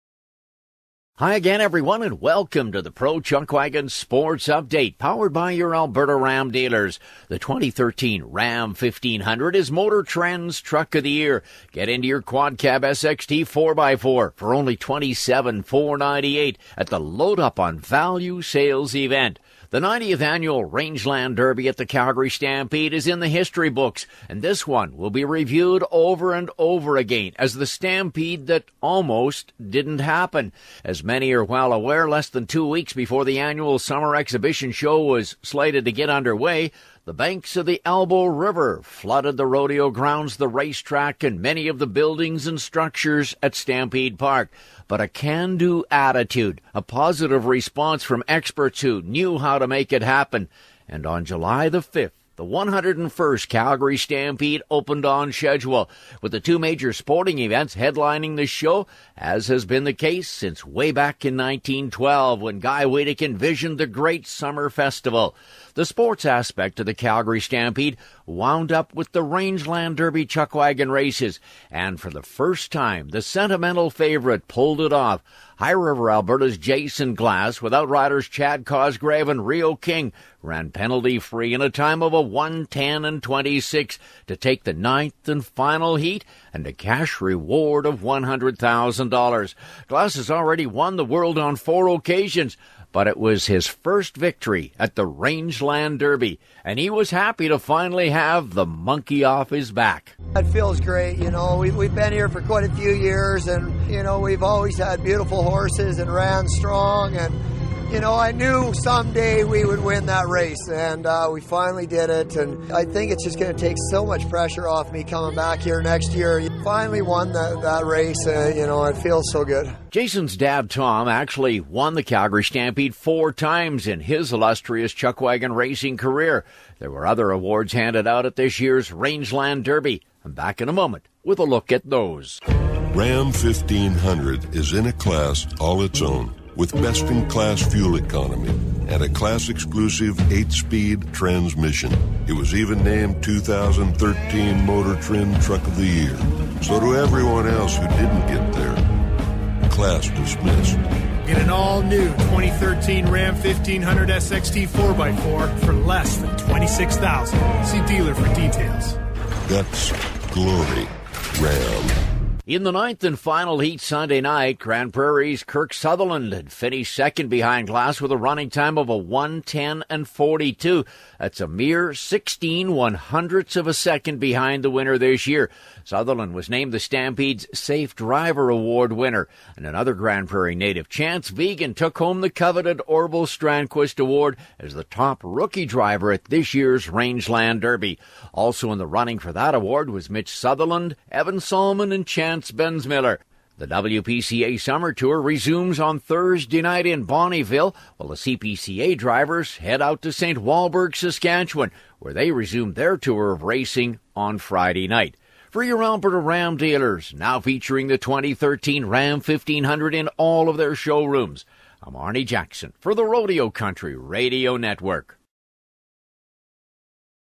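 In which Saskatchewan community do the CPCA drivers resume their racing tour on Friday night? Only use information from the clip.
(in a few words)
St. Walburg.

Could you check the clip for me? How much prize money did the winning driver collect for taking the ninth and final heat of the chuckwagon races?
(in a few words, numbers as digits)
$100,000.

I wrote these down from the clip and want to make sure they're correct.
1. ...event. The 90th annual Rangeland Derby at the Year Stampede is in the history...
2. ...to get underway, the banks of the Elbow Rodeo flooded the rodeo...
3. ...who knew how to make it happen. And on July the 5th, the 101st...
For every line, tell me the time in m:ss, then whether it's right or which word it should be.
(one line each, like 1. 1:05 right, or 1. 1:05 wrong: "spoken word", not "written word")
1. 0:18 wrong: "Calgary", not "Year"
2. 0:35 wrong: "River", not "Rodeo"
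3. 0:48 right.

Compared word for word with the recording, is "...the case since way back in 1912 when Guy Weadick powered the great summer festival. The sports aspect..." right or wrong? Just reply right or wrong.
wrong.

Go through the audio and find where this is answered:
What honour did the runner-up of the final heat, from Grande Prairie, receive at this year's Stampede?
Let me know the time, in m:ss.
2:57.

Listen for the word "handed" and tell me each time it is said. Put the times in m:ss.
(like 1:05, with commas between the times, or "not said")
2:07.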